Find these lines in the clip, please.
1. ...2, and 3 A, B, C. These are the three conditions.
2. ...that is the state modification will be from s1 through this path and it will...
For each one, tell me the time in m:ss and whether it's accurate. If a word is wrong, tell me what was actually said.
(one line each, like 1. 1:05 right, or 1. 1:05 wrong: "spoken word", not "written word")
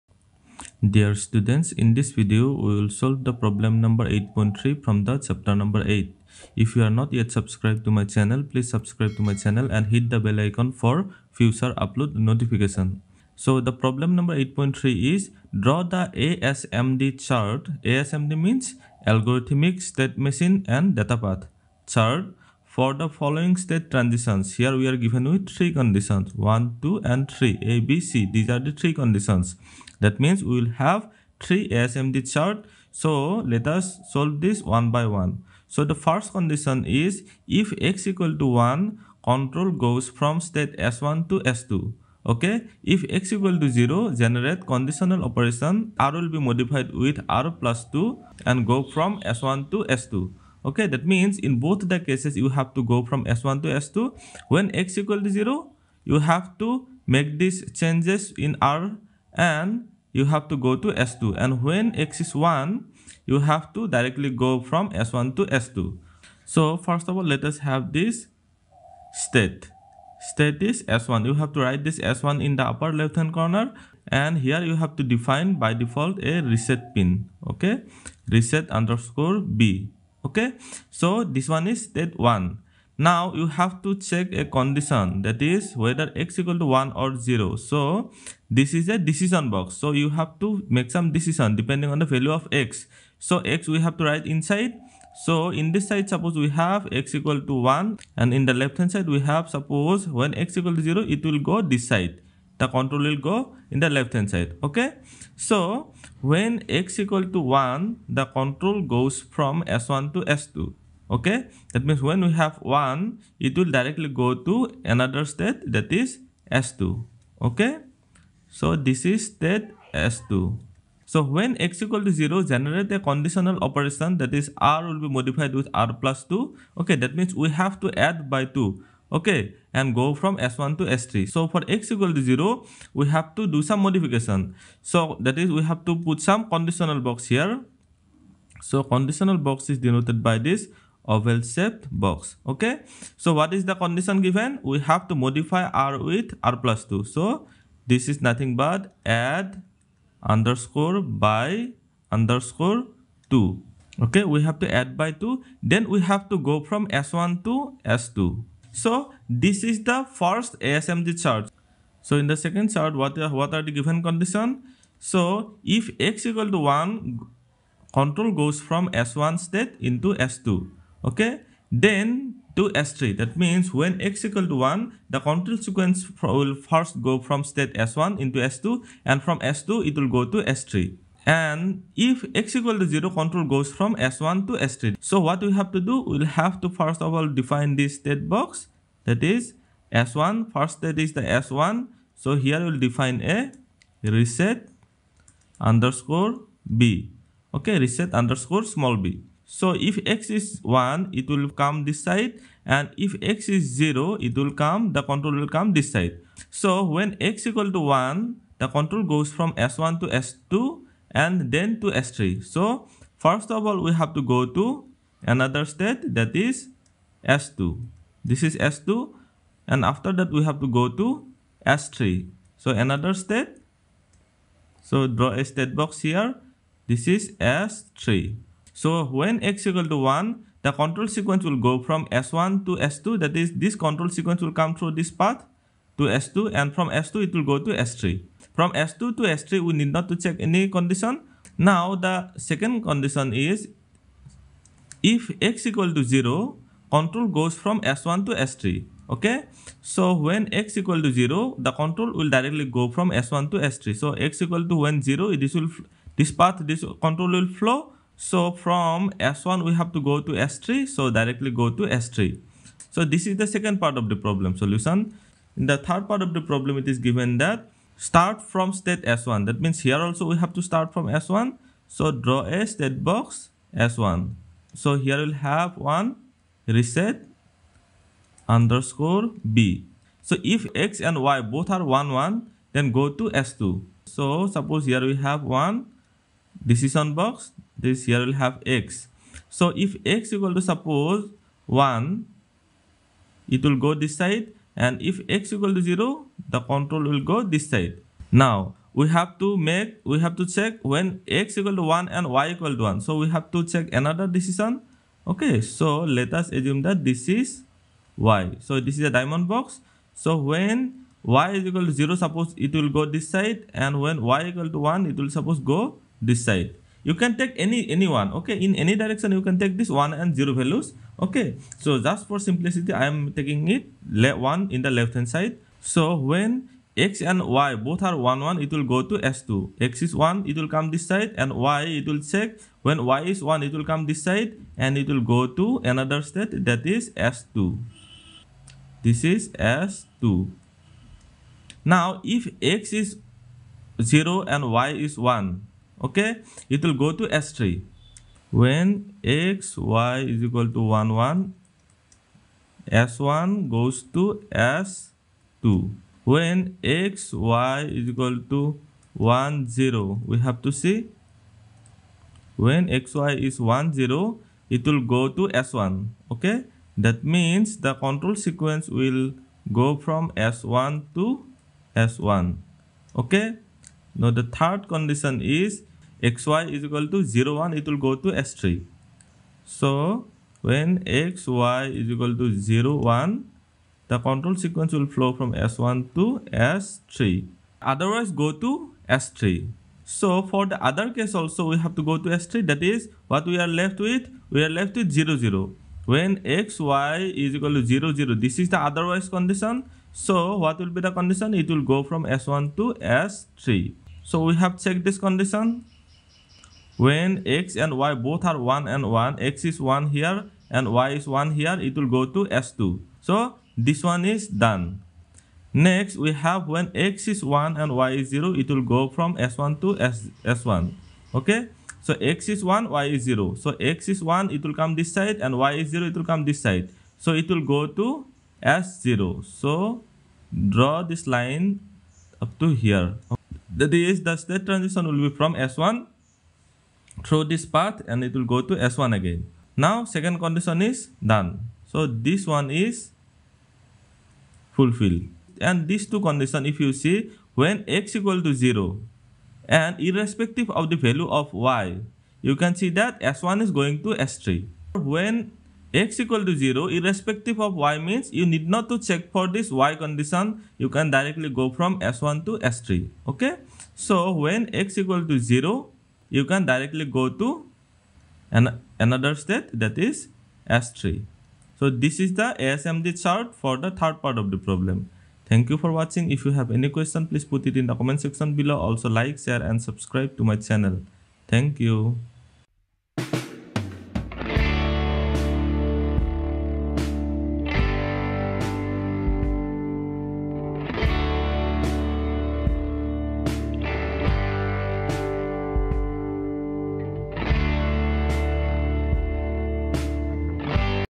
1. 0:26 right
2. 7:13 wrong: "transition", not "modification".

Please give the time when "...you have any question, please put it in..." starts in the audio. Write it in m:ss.
7:56.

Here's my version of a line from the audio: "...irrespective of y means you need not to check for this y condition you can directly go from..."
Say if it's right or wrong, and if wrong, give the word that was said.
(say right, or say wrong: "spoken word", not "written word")
right.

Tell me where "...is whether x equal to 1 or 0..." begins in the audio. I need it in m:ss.
1:25.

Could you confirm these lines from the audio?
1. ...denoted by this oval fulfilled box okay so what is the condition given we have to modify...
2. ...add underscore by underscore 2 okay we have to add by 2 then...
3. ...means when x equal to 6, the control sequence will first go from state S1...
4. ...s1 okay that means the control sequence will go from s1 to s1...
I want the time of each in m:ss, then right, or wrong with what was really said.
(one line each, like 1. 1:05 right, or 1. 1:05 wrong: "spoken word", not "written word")
1. 2:19 wrong: "shaped", not "fulfilled"
2. 2:29 right
3. 2:53 wrong: "1", not "6"
4. 6:05 right.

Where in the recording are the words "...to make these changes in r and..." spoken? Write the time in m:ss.
0:56.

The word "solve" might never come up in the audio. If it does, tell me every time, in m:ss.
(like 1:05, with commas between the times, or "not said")
0:02, 0:34.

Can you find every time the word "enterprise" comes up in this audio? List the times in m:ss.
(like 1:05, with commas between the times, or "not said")
not said.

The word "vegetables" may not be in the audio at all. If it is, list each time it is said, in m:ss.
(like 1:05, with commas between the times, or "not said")
not said.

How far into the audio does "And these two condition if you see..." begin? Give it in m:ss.
7:25.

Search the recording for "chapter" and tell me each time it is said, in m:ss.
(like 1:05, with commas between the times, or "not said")
0:05.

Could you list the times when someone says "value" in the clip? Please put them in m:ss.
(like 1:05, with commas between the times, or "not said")
1:32, 5:20, 7:30.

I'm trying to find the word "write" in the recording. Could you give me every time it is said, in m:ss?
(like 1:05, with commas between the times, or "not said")
1:11, 1:34.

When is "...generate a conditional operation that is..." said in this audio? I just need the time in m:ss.
2:02.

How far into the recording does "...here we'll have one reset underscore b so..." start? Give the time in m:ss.
4:34.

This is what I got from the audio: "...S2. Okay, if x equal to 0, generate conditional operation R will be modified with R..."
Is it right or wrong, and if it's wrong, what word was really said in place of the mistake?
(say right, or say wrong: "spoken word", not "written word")
right.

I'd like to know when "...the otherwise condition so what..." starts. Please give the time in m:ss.
6:38.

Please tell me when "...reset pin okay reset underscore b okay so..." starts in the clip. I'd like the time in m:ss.
1:16.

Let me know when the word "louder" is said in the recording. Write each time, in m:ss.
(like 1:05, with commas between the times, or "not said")
not said.